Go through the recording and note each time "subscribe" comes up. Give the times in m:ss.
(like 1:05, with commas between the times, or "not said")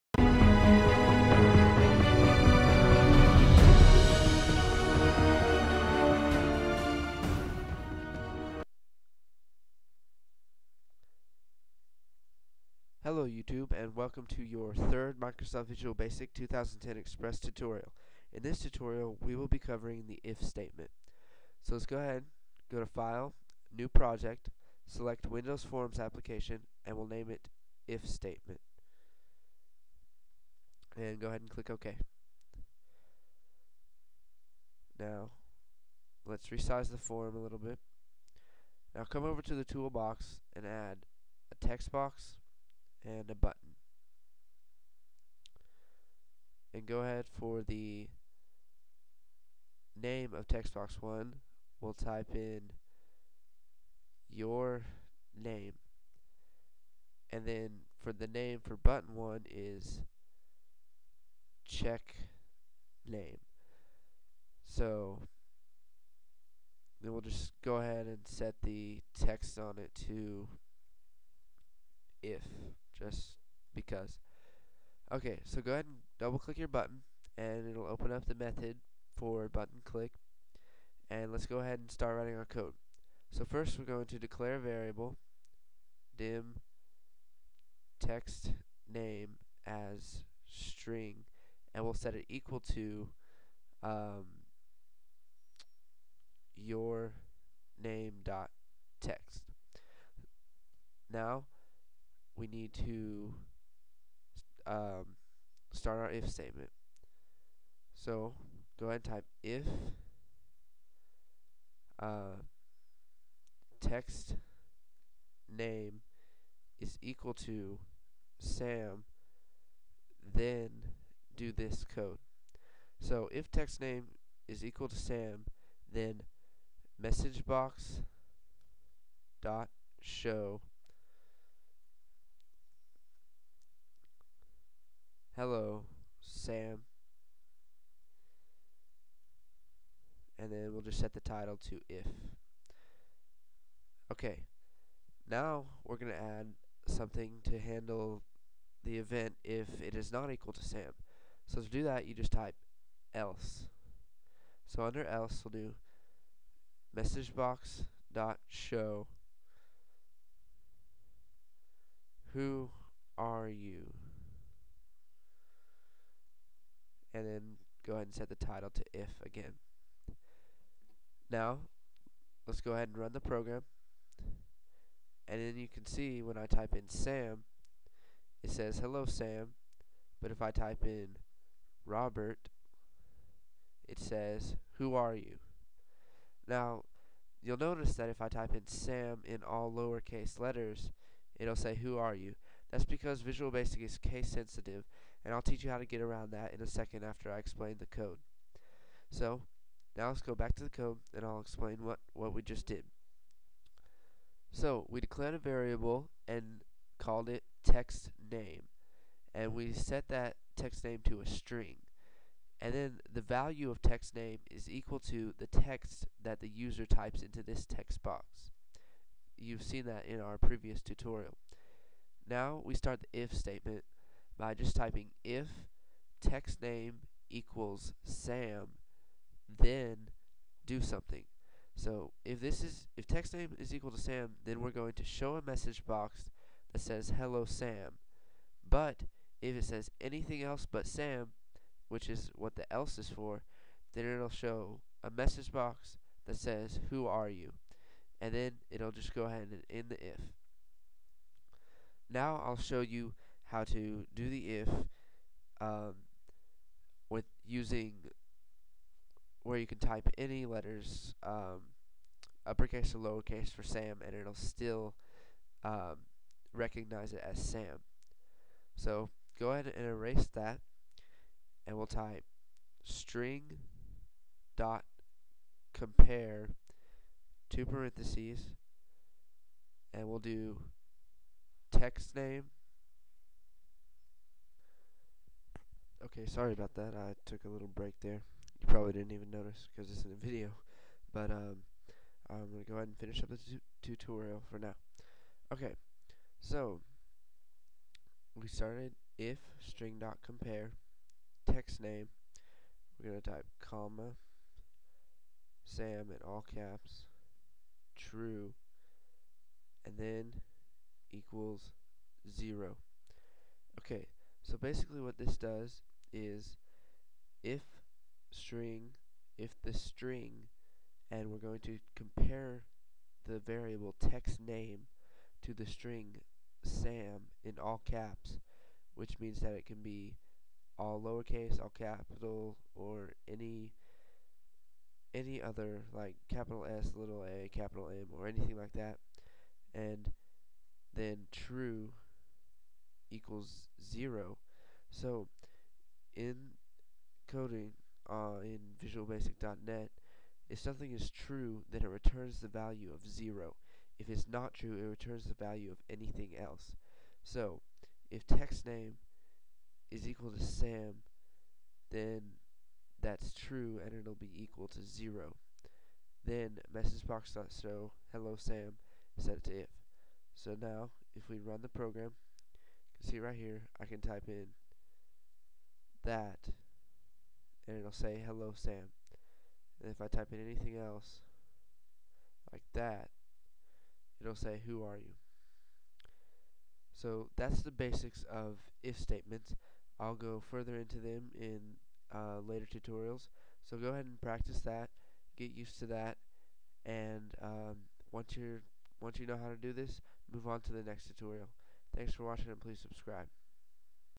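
6:42.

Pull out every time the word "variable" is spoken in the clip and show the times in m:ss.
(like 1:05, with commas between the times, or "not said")
1:24, 3:25, 5:23.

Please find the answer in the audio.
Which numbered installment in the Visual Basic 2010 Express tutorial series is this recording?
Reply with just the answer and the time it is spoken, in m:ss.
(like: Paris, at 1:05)
third, at 0:14.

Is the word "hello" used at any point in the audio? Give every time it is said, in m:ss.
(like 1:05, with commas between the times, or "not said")
0:13, 2:15, 2:58, 3:57, 6:08, 6:18.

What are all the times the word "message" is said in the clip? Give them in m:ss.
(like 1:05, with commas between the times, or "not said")
2:06, 2:36, 3:55, 4:05, 6:06.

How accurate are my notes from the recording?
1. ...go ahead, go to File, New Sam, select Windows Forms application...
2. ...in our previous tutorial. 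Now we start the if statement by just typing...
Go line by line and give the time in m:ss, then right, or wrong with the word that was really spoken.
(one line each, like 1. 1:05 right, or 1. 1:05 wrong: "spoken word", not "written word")
1. 0:21 wrong: "Project", not "Sam"
2. 3:40 right.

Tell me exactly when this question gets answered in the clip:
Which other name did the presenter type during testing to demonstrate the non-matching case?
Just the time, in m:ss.
3:01.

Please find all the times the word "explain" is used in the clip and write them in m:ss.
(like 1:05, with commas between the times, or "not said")
3:17, 3:21.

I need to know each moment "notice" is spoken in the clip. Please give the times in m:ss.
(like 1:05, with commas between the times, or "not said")
3:07, 4:49.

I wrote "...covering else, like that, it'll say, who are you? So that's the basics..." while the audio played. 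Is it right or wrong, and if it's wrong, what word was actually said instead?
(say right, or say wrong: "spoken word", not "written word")
wrong: "anything", not "covering".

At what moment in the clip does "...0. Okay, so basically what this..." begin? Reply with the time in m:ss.
5:12.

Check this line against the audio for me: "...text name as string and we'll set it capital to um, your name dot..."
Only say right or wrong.
wrong.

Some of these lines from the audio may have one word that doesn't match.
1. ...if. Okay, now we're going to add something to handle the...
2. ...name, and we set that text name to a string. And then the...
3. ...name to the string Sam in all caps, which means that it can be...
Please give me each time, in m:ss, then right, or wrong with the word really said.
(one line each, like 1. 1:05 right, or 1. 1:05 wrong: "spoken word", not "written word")
1. 2:21 right
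2. 3:28 right
3. 5:24 right.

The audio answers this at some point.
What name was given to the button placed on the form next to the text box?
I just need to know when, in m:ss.
1:01.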